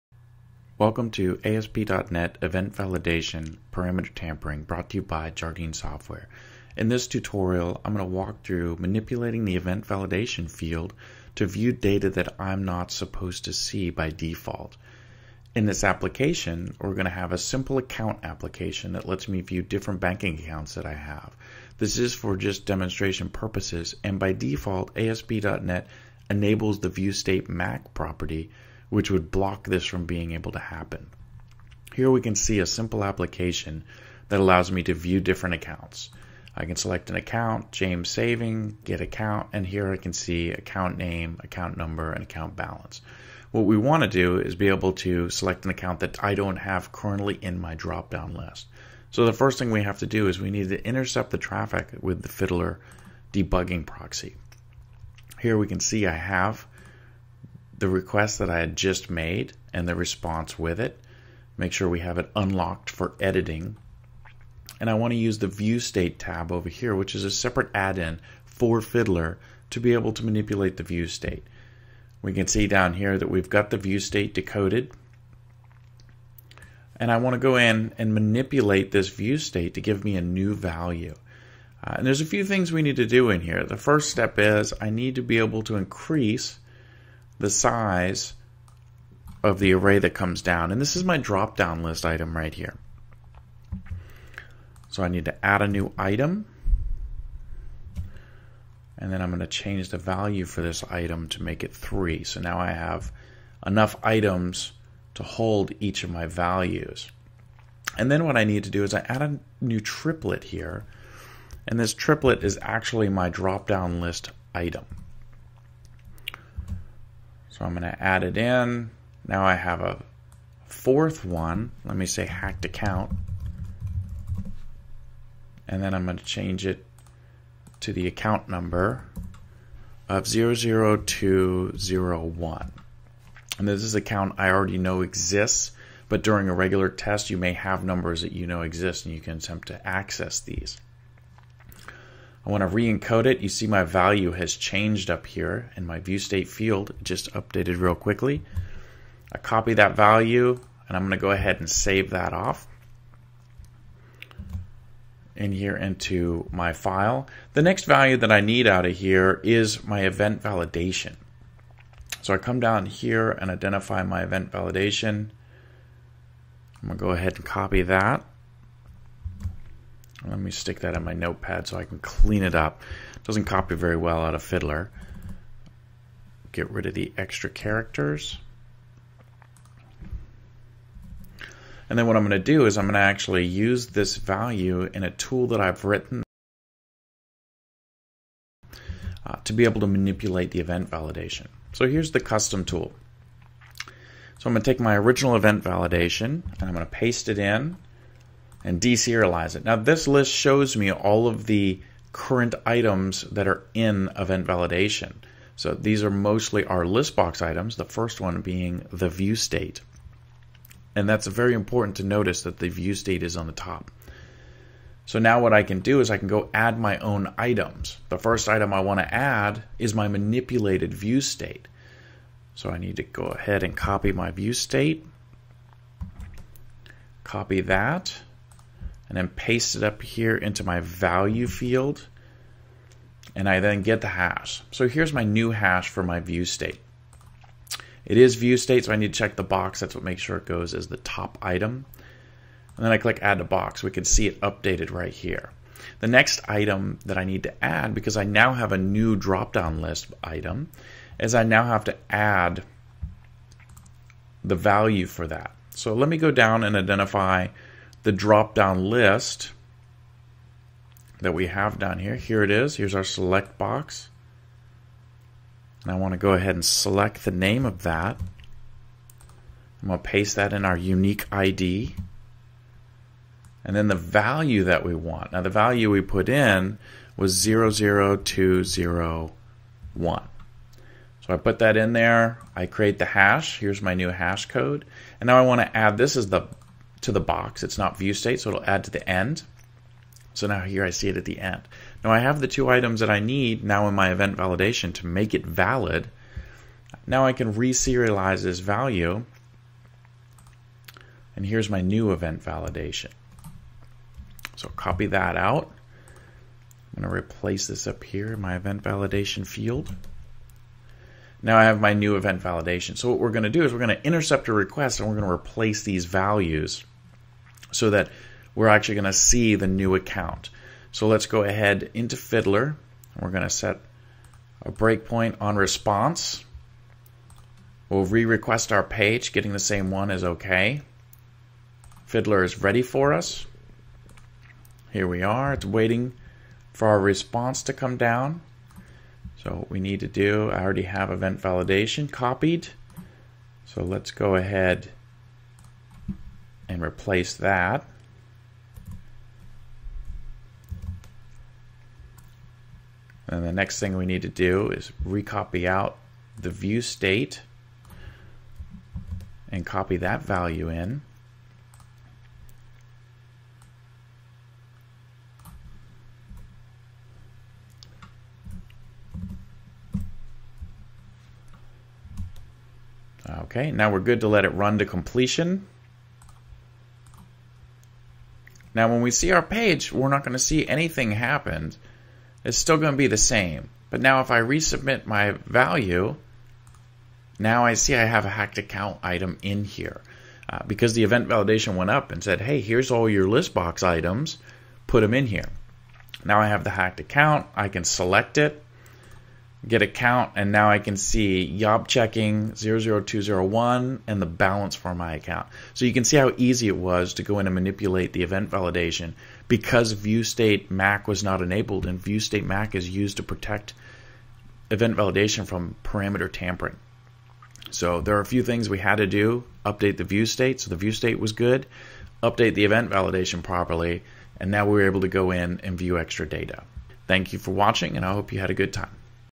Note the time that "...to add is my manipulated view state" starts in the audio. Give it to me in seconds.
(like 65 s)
218 s.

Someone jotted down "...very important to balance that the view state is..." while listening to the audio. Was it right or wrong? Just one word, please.
wrong.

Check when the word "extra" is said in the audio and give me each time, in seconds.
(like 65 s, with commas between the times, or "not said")
177 s, 425 s.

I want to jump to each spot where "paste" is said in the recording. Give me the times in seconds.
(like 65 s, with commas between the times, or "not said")
196 s, 229 s, 270 s.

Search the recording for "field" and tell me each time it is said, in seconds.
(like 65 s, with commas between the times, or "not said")
10 s, 146 s, 231 s, 309 s.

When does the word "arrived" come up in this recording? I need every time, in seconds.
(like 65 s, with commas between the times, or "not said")
not said.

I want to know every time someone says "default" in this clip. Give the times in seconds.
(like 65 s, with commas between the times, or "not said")
14 s, 24 s.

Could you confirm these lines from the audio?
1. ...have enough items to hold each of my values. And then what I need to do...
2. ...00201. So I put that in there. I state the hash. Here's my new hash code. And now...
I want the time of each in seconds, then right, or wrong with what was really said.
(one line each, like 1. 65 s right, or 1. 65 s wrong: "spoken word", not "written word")
1. 102 s right
2. 277 s wrong: "create", not "state".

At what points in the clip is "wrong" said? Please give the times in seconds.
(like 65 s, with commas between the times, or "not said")
not said.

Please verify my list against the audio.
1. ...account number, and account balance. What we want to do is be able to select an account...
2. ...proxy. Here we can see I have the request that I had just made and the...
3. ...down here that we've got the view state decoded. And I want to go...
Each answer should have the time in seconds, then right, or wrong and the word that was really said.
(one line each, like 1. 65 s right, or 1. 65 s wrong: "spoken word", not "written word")
1. 41 s right
2. 53 s right
3. 72 s right.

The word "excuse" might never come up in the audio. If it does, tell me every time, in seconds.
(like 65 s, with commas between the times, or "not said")
not said.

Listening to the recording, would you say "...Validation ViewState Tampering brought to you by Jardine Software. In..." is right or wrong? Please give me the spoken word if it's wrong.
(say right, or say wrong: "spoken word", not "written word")
wrong: "Parameter", not "ViewState".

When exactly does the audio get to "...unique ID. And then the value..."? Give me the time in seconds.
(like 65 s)
270 s.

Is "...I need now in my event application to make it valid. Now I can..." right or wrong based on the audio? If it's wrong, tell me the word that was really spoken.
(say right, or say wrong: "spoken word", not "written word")
wrong: "validation", not "application".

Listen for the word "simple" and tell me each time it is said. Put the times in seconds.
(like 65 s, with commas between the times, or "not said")
17 s, 32 s.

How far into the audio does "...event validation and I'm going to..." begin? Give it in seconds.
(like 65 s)
195 s.